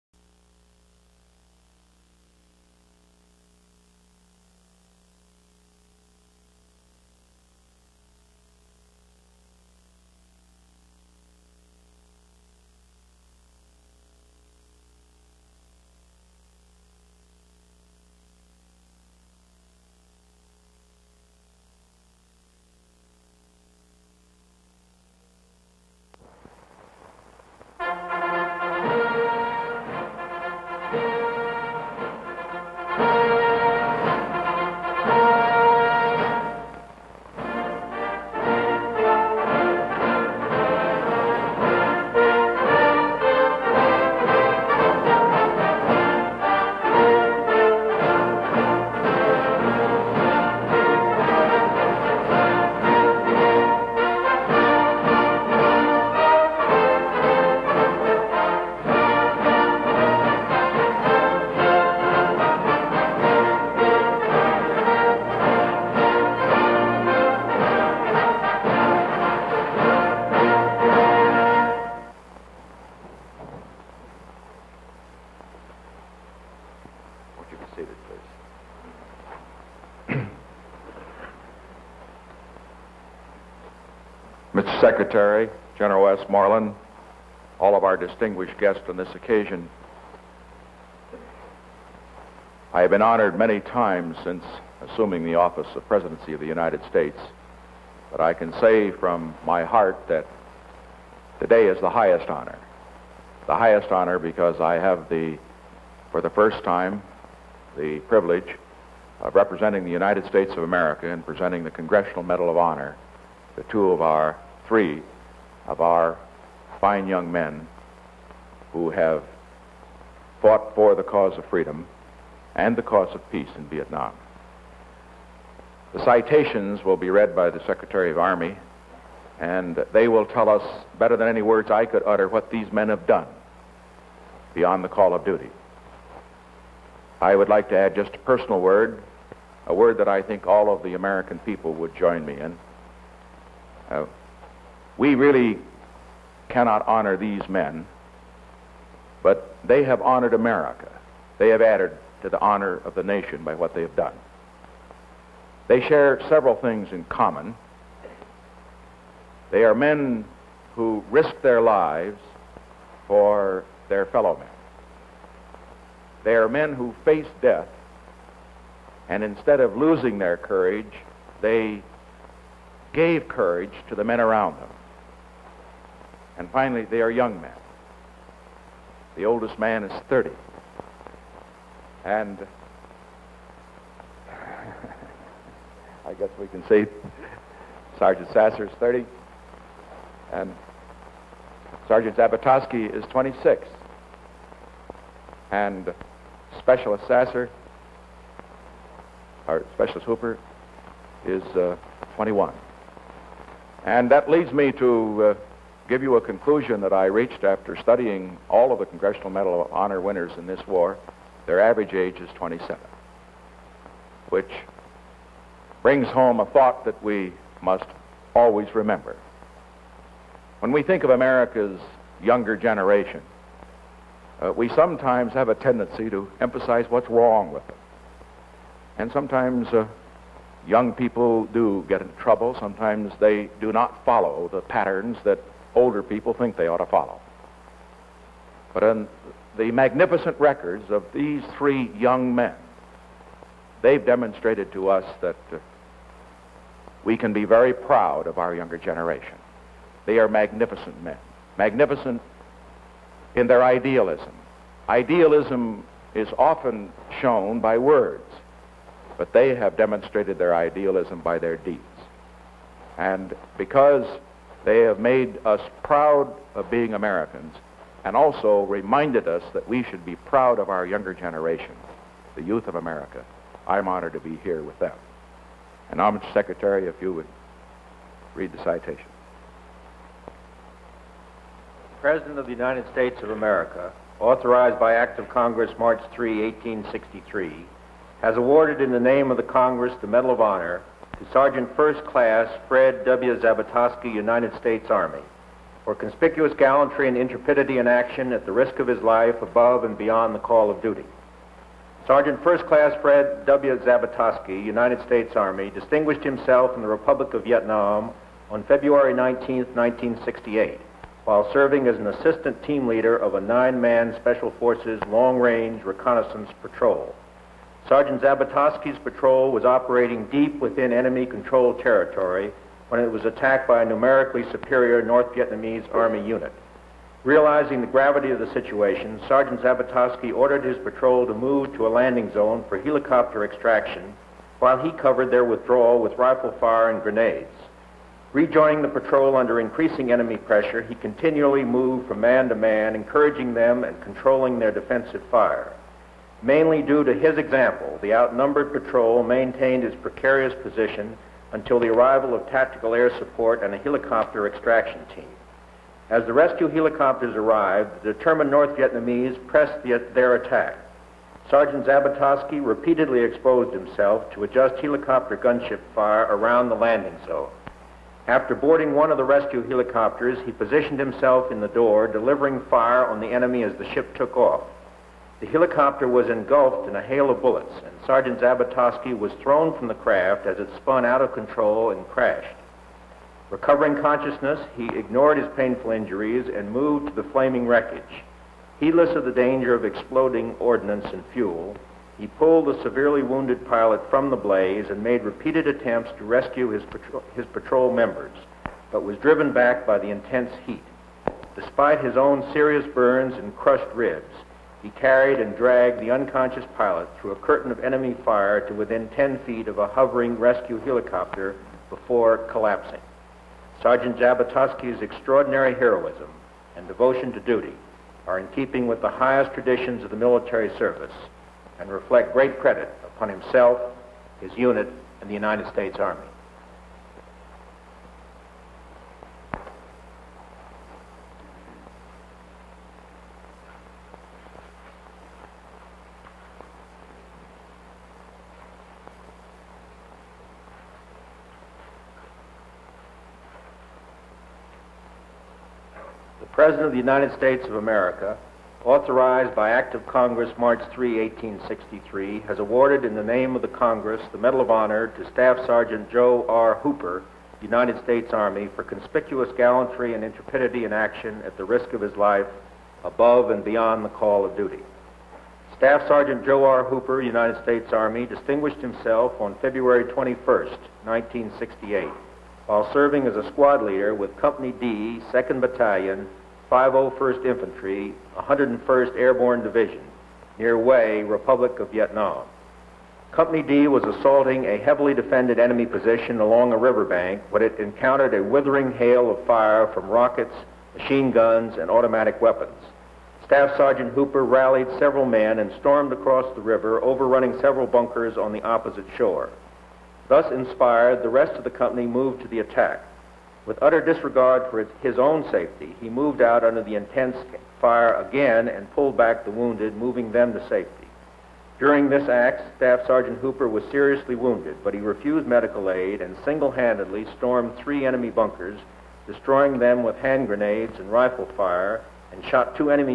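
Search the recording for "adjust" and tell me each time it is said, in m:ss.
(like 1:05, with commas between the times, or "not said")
6:04.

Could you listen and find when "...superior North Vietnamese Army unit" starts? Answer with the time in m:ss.
5:24.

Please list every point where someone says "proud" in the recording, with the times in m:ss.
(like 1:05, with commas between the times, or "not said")
4:07, 4:25, 4:30.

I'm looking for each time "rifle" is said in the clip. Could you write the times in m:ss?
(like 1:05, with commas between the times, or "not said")
5:36, 8:41.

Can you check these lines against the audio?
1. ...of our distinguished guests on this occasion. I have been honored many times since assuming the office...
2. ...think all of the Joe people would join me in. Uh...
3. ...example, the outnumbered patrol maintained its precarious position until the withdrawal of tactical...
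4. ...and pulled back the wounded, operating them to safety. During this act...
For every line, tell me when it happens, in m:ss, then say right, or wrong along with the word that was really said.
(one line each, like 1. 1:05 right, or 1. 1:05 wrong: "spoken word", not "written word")
1. 1:27 right
2. 2:20 wrong: "American", not "Joe"
3. 5:47 wrong: "arrival", not "withdrawal"
4. 8:28 wrong: "moving", not "operating".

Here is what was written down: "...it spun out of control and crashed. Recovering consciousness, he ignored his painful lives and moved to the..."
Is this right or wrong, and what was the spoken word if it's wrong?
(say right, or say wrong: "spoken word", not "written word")
wrong: "injuries", not "lives".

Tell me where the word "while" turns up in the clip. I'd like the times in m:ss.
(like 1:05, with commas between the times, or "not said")
5:11, 5:34, 7:52.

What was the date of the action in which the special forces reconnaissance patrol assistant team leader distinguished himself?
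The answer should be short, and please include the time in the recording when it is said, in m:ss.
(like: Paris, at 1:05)
February 19, 1968, at 5:08.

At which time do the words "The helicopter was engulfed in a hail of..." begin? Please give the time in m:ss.
6:15.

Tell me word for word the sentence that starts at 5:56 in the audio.
As the rescue helicopters arrived, the determined North Vietnamese pressed the, their attack.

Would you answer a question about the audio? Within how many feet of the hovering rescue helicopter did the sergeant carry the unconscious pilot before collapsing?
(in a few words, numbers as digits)
10.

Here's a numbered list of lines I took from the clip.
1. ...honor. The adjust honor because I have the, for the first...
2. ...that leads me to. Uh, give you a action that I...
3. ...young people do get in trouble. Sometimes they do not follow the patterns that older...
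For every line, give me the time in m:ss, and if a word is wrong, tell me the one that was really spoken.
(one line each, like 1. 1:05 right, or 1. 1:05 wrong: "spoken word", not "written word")
1. 1:42 wrong: "highest", not "adjust"
2. 3:24 wrong: "conclusion", not "action"
3. 3:50 right.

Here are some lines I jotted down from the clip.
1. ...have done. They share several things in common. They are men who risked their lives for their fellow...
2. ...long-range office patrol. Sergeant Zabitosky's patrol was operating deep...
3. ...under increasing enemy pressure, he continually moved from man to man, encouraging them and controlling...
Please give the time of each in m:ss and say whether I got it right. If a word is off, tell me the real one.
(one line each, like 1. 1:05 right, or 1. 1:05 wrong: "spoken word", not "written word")
1. 2:33 right
2. 5:15 wrong: "reconnaissance", not "office"
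3. 5:39 right.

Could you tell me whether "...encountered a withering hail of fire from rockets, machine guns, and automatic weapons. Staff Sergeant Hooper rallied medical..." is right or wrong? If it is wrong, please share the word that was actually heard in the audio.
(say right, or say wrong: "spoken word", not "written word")
wrong: "several", not "medical".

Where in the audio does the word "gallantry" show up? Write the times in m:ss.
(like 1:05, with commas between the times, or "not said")
4:56, 7:39.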